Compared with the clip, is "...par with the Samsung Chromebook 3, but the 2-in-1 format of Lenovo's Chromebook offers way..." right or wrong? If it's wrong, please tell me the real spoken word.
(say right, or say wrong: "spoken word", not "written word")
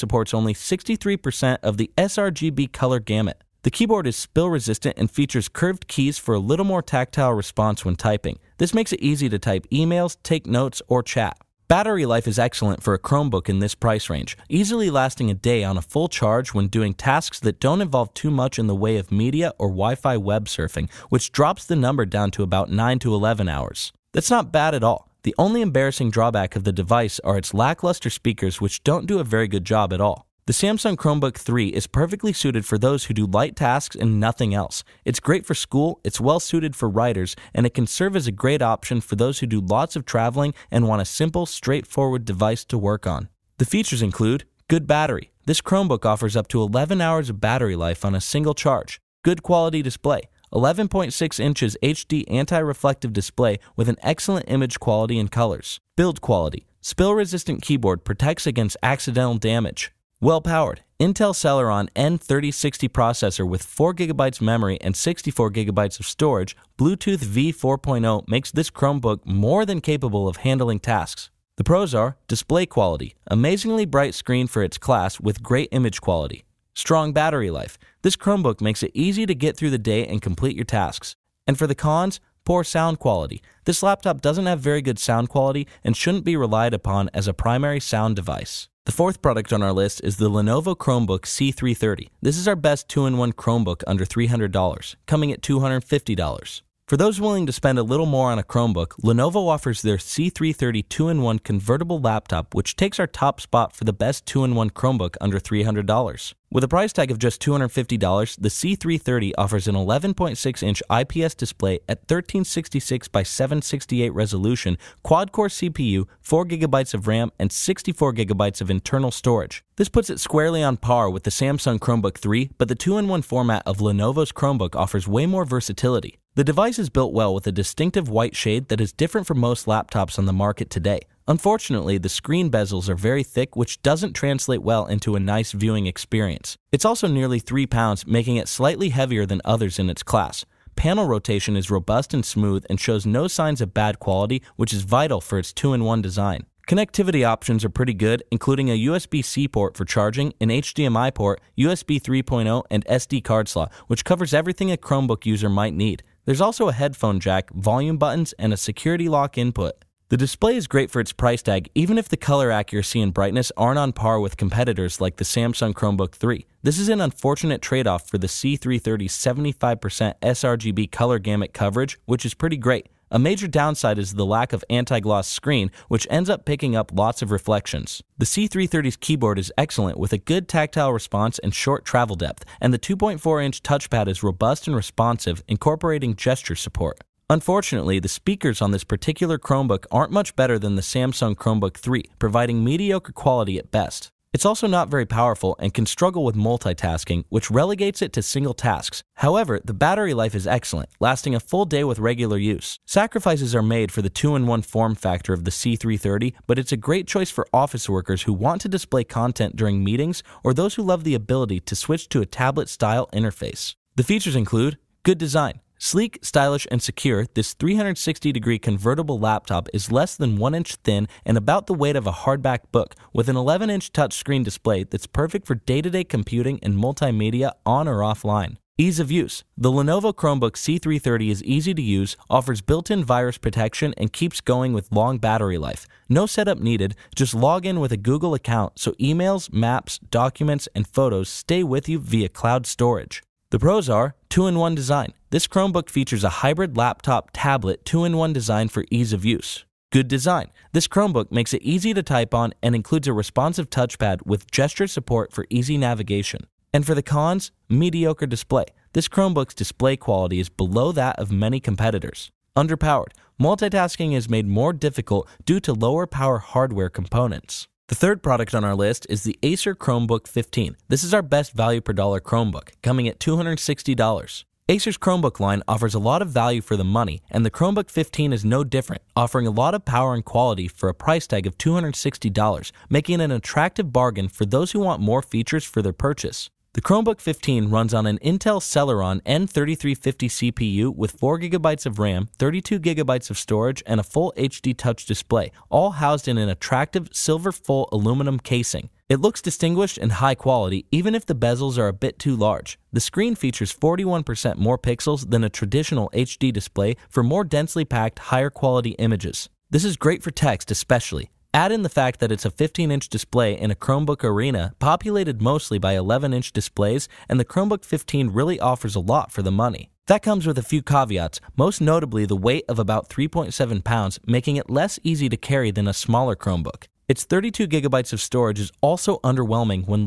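right.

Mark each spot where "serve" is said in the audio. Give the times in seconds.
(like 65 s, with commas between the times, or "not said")
37 s.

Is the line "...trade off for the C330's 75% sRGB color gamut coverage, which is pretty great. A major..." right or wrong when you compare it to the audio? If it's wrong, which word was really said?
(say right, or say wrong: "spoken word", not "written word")
right.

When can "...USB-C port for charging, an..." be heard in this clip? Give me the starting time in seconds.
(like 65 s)
148 s.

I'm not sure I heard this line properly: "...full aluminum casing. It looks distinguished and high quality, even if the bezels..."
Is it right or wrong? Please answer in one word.
right.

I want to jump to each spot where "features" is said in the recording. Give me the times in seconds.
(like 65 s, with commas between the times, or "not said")
5 s, 43 s, 214 s, 245 s, 285 s, 303 s.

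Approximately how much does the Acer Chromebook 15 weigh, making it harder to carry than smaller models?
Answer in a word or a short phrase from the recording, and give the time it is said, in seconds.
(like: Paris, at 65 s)
3.7 pounds, at 323 s.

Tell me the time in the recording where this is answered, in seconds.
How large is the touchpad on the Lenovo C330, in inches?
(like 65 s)
182 s.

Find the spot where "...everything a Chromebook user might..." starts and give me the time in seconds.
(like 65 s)
154 s.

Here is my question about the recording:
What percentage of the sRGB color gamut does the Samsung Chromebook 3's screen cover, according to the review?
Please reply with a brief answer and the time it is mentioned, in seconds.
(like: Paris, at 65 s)
63%, at 0 s.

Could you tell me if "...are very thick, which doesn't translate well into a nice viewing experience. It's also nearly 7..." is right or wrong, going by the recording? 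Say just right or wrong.
wrong.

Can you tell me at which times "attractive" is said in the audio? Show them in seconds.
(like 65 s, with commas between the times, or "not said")
283 s, 296 s.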